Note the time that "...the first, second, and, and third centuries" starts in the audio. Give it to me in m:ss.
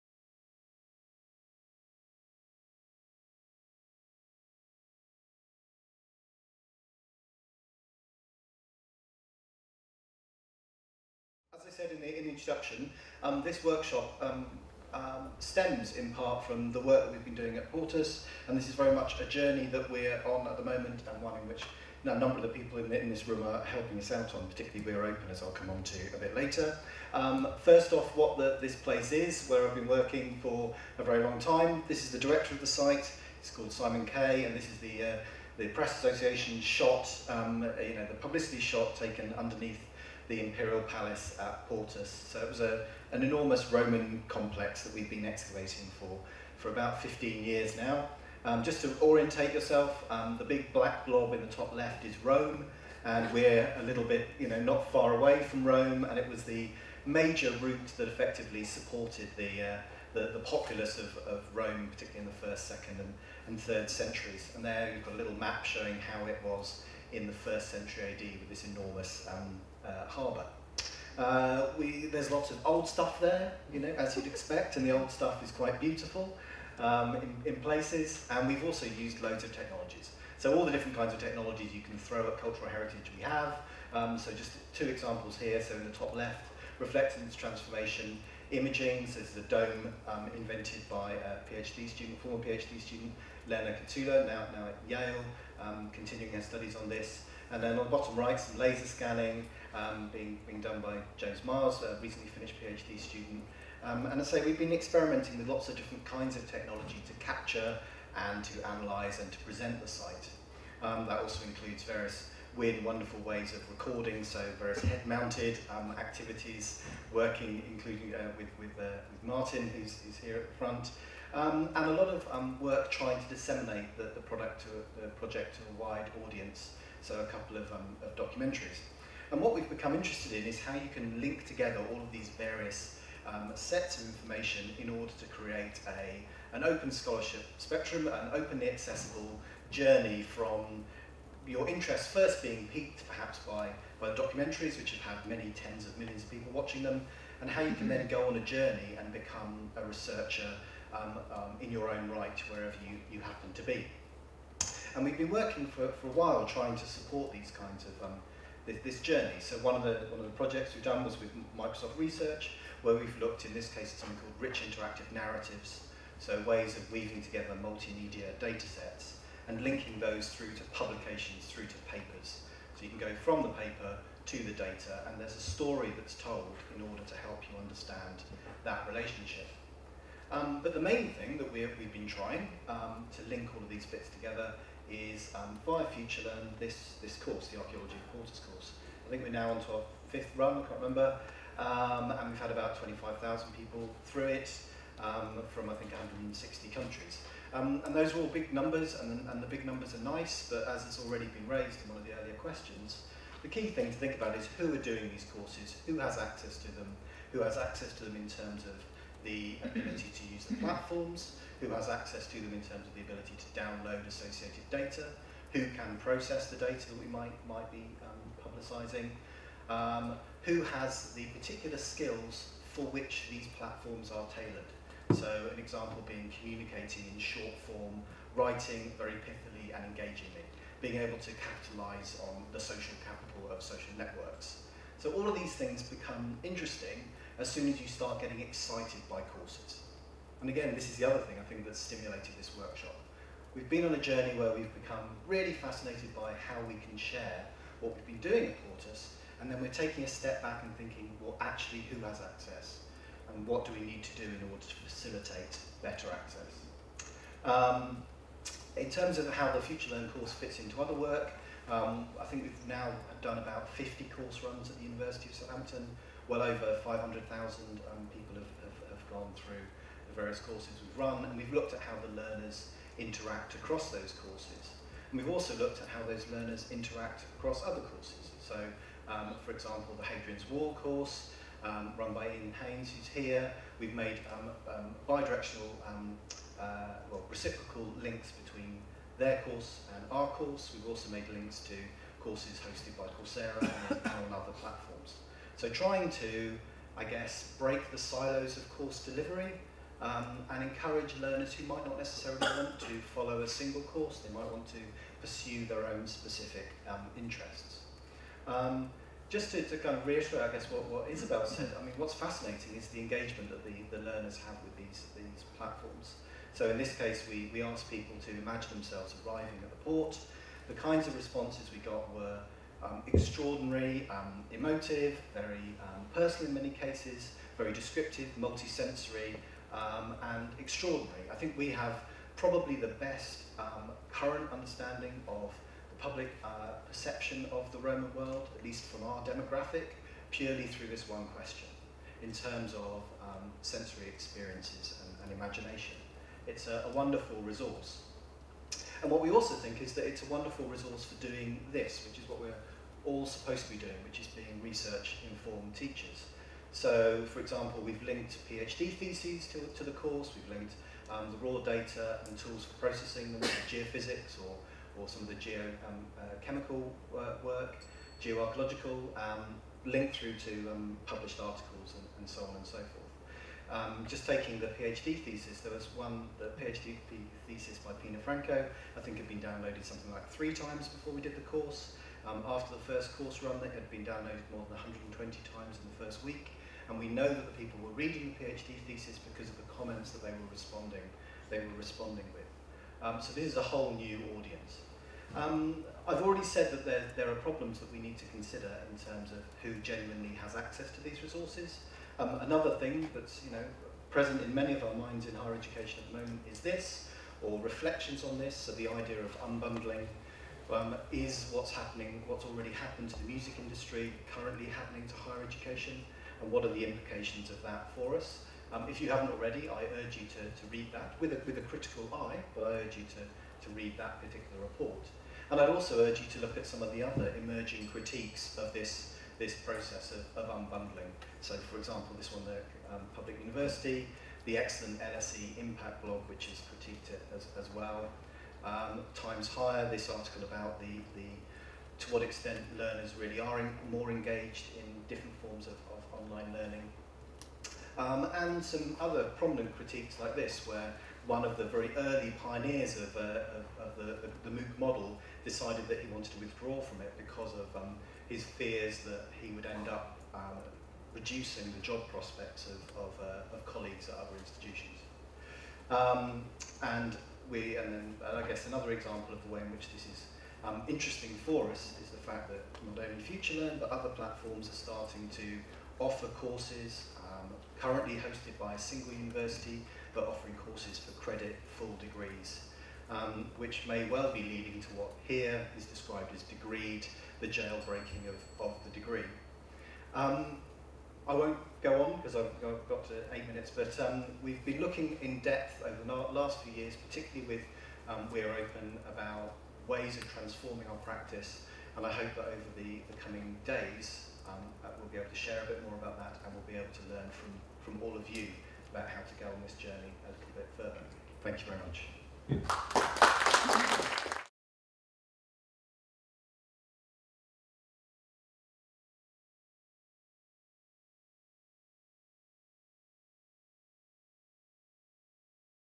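1:02.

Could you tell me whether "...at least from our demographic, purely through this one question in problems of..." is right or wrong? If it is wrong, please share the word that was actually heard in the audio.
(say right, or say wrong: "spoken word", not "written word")
wrong: "terms", not "problems".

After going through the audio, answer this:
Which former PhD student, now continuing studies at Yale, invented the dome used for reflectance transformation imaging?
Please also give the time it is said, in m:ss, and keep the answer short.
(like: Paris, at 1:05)
Lena Kotoula, at 1:33.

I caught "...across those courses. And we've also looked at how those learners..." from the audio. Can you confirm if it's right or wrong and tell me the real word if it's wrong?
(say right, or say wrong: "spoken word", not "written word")
right.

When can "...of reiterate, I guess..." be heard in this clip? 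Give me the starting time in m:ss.
5:09.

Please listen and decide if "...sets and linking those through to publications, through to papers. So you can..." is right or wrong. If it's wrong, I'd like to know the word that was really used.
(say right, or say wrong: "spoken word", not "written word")
right.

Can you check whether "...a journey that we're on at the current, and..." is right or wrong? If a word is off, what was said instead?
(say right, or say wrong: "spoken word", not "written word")
wrong: "moment", not "current".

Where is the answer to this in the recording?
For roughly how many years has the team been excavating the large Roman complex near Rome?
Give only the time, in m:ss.
0:47.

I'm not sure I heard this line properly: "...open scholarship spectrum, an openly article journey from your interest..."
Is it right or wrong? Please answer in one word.
wrong.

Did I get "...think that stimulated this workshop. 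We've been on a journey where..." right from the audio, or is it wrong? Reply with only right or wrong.
right.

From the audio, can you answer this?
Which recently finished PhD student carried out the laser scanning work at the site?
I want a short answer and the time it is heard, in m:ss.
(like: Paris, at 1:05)
James Miles, at 1:41.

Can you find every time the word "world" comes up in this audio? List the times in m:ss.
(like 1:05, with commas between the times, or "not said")
5:38.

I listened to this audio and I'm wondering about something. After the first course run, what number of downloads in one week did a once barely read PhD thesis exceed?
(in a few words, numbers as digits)
120.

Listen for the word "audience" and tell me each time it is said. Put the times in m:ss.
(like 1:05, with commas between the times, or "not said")
2:06, 6:34.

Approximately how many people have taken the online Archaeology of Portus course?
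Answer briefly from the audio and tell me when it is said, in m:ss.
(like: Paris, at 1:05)
25,000, at 3:12.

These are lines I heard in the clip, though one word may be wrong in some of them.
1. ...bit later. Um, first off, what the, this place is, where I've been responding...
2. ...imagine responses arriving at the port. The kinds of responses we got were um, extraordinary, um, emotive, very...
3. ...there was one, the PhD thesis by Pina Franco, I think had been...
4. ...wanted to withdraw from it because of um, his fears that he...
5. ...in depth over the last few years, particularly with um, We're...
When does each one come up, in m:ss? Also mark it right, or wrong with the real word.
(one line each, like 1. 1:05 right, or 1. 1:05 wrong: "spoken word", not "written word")
1. 0:26 wrong: "working", not "responding"
2. 5:18 wrong: "themselves", not "responses"
3. 6:15 right
4. 7:36 right
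5. 8:15 right.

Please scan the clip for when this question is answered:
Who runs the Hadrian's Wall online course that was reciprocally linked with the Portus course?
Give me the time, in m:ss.
4:42.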